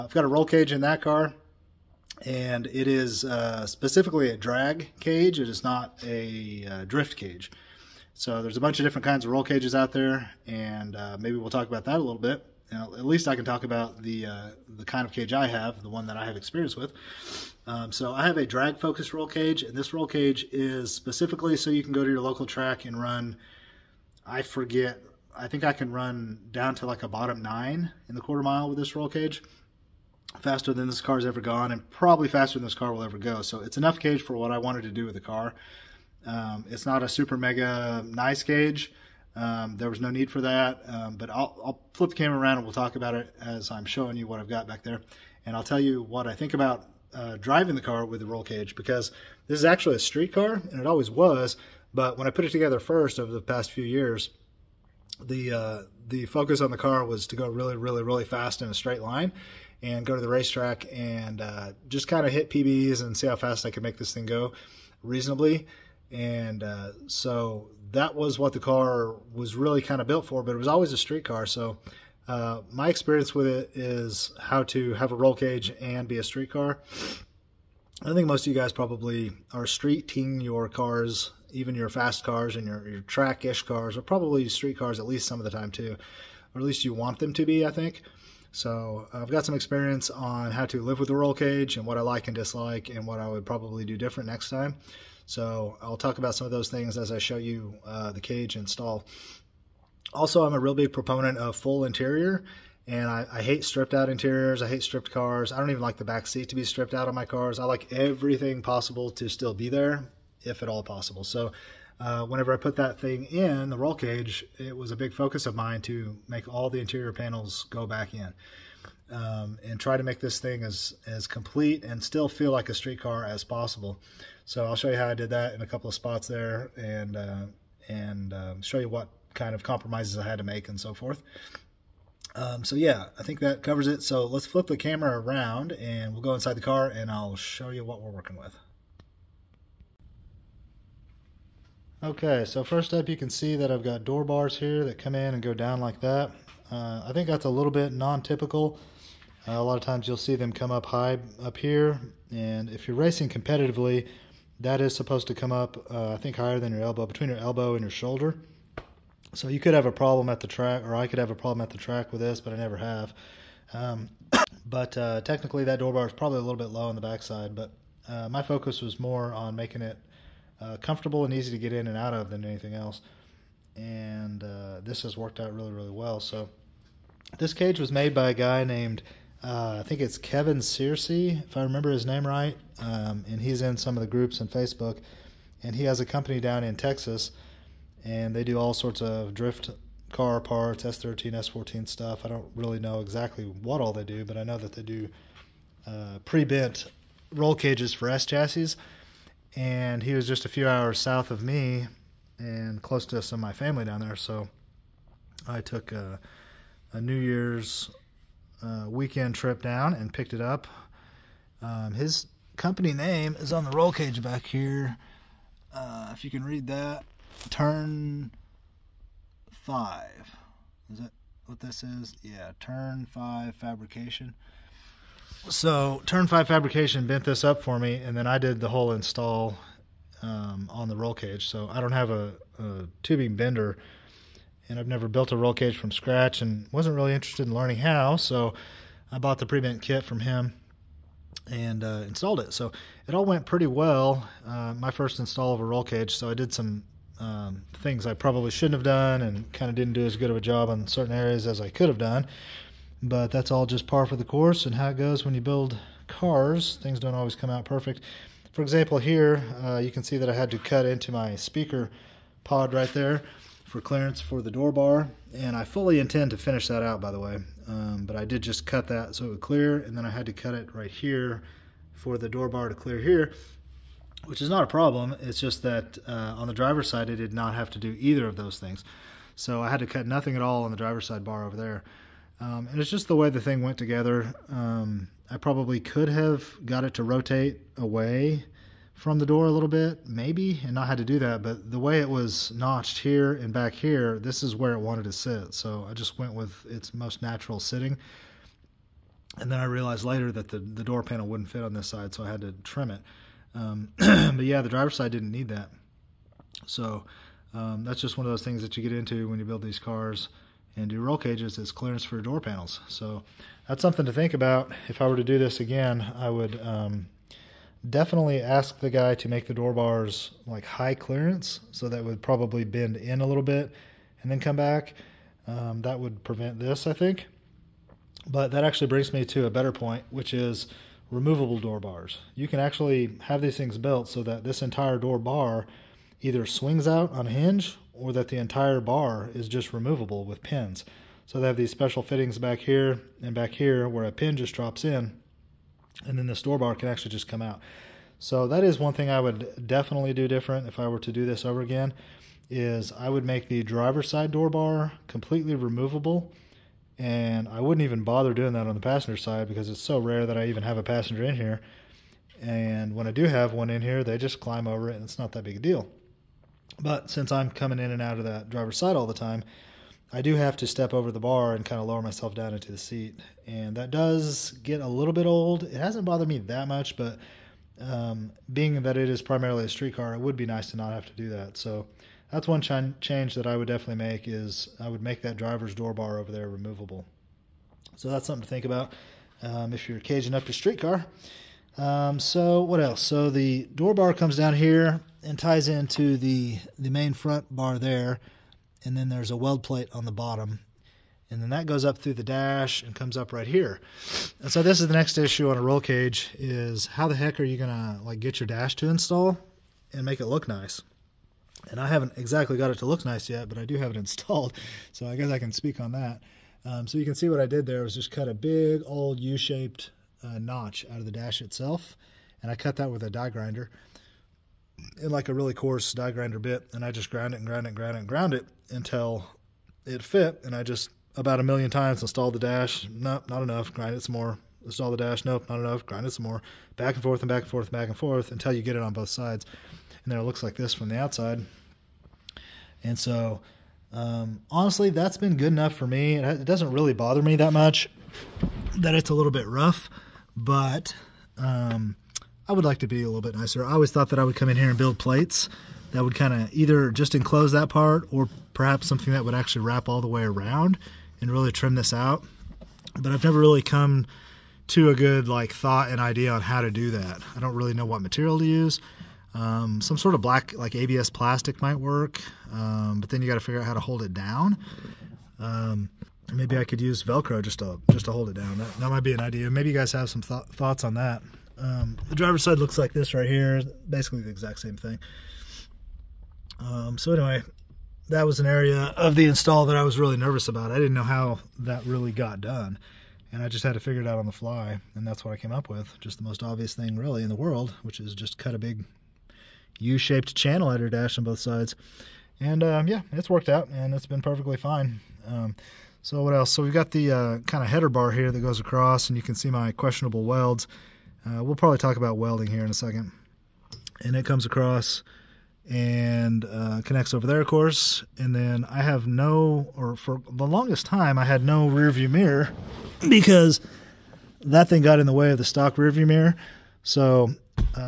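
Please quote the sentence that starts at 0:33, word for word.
So it's enough cage for what I wanted to do with the car.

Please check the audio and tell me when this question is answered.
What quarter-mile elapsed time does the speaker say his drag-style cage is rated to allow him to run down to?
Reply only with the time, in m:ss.
0:27.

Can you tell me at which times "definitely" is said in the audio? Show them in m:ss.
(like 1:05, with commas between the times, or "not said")
5:17, 5:49, 6:23.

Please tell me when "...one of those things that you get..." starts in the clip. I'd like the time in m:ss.
5:08.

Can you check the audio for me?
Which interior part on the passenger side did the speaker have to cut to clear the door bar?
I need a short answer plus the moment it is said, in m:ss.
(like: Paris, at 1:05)
speaker pod, at 4:21.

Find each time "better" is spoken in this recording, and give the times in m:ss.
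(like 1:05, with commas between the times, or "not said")
5:29.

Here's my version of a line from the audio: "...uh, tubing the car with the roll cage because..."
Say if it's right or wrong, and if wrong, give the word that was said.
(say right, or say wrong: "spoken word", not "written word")
wrong: "driving", not "tubing".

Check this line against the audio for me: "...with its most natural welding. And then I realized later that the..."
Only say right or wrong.
wrong.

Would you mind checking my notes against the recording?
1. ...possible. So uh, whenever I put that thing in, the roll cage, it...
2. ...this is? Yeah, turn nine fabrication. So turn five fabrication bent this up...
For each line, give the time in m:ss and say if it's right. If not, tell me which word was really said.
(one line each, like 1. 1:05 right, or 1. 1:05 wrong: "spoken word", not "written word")
1. 1:50 right
2. 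3:41 wrong: "five", not "nine".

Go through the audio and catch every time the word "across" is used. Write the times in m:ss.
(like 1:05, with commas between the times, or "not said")
8:28, 8:34.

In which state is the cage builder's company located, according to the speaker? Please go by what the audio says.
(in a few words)
Texas.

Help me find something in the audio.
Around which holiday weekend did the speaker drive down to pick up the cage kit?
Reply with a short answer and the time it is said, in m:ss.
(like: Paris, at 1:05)
New Year's, at 3:27.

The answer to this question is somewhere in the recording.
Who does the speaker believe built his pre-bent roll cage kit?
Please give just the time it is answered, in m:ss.
3:00.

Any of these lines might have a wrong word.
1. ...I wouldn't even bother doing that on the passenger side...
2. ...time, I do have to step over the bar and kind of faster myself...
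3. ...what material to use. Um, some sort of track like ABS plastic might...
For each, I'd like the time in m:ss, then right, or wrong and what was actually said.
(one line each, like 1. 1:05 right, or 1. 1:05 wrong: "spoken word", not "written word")
1. 5:57 right
2. 6:09 wrong: "lower", not "faster"
3. 7:47 wrong: "black", not "track".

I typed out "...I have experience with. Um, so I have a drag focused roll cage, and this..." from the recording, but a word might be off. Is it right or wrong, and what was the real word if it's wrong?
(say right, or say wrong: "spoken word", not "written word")
right.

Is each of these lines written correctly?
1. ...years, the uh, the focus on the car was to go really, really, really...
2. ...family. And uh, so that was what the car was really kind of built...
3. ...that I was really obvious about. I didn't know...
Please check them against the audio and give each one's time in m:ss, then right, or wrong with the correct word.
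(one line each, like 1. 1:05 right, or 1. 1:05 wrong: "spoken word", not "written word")
1. 0:53 right
2. 1:05 wrong: "reasonably", not "family"
3. 8:09 wrong: "nervous", not "obvious".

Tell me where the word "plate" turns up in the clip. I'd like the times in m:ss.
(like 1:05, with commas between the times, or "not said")
6:39, 7:34.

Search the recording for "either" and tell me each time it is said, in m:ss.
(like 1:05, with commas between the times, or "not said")
4:37, 5:36, 7:36.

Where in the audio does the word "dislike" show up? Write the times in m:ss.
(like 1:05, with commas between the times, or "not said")
1:32.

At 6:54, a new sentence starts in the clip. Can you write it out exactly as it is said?
So I guess I can speak on that.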